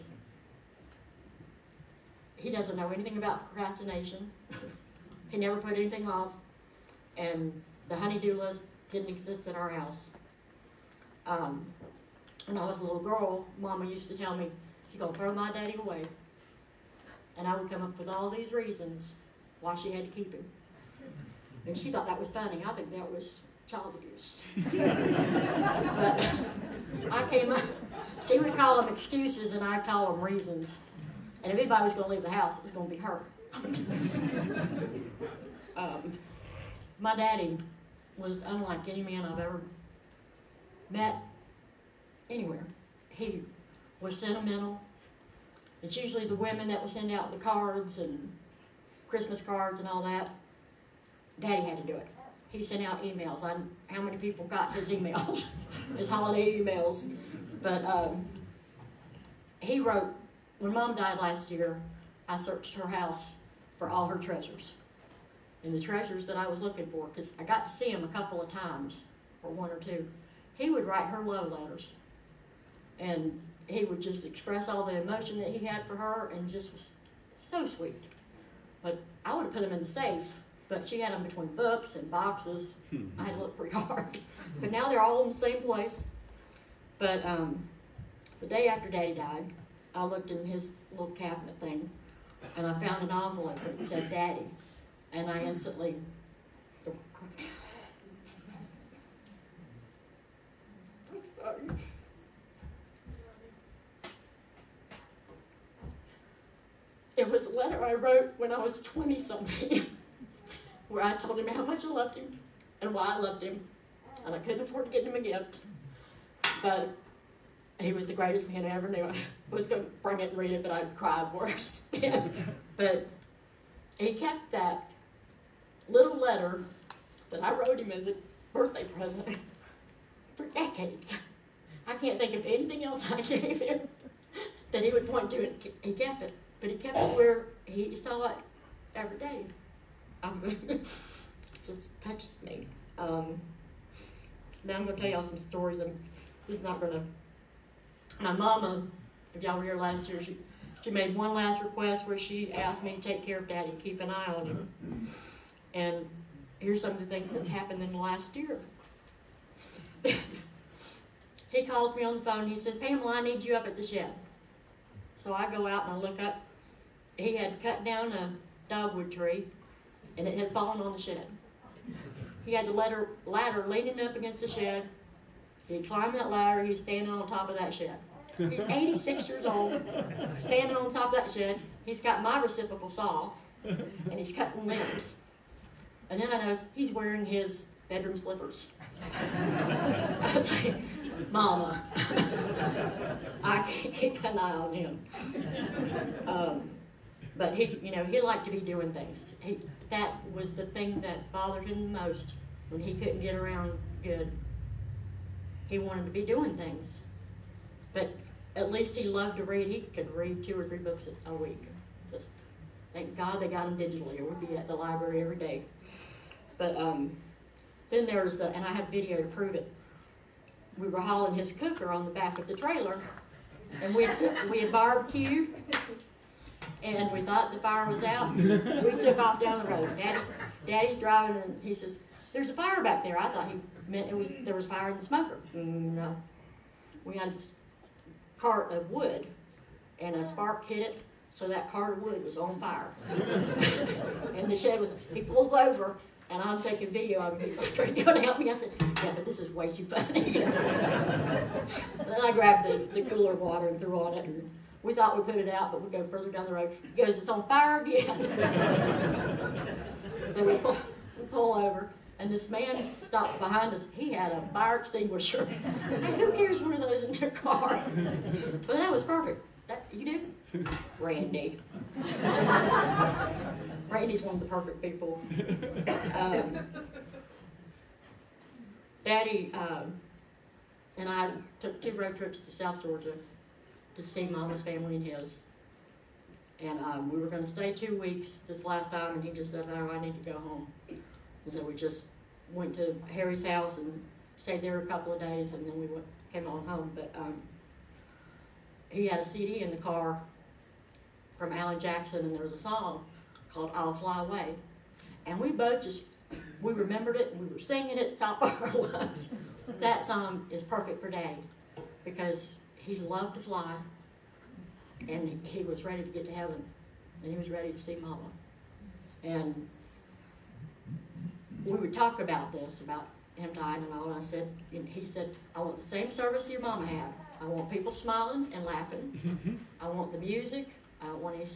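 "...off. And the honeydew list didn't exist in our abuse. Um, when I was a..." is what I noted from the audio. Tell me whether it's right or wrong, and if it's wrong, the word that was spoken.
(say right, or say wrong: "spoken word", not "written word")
wrong: "house", not "abuse".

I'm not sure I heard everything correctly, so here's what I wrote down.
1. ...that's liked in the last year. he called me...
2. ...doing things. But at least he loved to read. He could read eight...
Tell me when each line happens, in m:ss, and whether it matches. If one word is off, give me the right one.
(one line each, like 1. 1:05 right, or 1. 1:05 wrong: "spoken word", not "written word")
1. 2:37 wrong: "happened", not "liked"
2. 3:26 wrong: "two", not "eight".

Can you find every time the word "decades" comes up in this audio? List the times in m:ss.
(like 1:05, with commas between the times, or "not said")
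2:10.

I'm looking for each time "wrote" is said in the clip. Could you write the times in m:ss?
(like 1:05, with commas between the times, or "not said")
0:59, 1:47, 2:07.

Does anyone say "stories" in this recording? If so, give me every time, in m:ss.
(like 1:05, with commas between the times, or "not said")
2:25.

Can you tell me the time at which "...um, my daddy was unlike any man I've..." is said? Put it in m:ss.
0:35.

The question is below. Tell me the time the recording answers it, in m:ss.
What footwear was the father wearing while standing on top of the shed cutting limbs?
3:07.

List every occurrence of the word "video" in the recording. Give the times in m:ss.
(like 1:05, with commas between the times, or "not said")
3:38, 4:06.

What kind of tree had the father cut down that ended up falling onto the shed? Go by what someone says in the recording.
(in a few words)
dogwood.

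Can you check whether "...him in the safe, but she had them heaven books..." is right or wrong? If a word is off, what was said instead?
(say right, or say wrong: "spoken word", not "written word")
wrong: "between", not "heaven".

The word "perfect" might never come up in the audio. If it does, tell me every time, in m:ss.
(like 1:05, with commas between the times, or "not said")
4:29, 4:34, 5:10.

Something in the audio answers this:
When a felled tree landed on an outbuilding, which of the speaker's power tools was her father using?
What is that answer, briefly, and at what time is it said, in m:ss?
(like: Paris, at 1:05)
reciprocal saw, at 3:02.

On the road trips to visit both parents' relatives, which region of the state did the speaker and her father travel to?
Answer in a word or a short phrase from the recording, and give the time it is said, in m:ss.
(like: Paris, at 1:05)
South Georgia, at 4:42.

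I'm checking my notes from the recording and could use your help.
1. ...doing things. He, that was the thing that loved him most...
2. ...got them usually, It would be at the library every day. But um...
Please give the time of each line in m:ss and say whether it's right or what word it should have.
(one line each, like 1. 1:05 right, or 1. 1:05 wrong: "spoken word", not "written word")
1. 3:18 wrong: "bothered", not "loved"
2. 3:33 wrong: "digitally", not "usually".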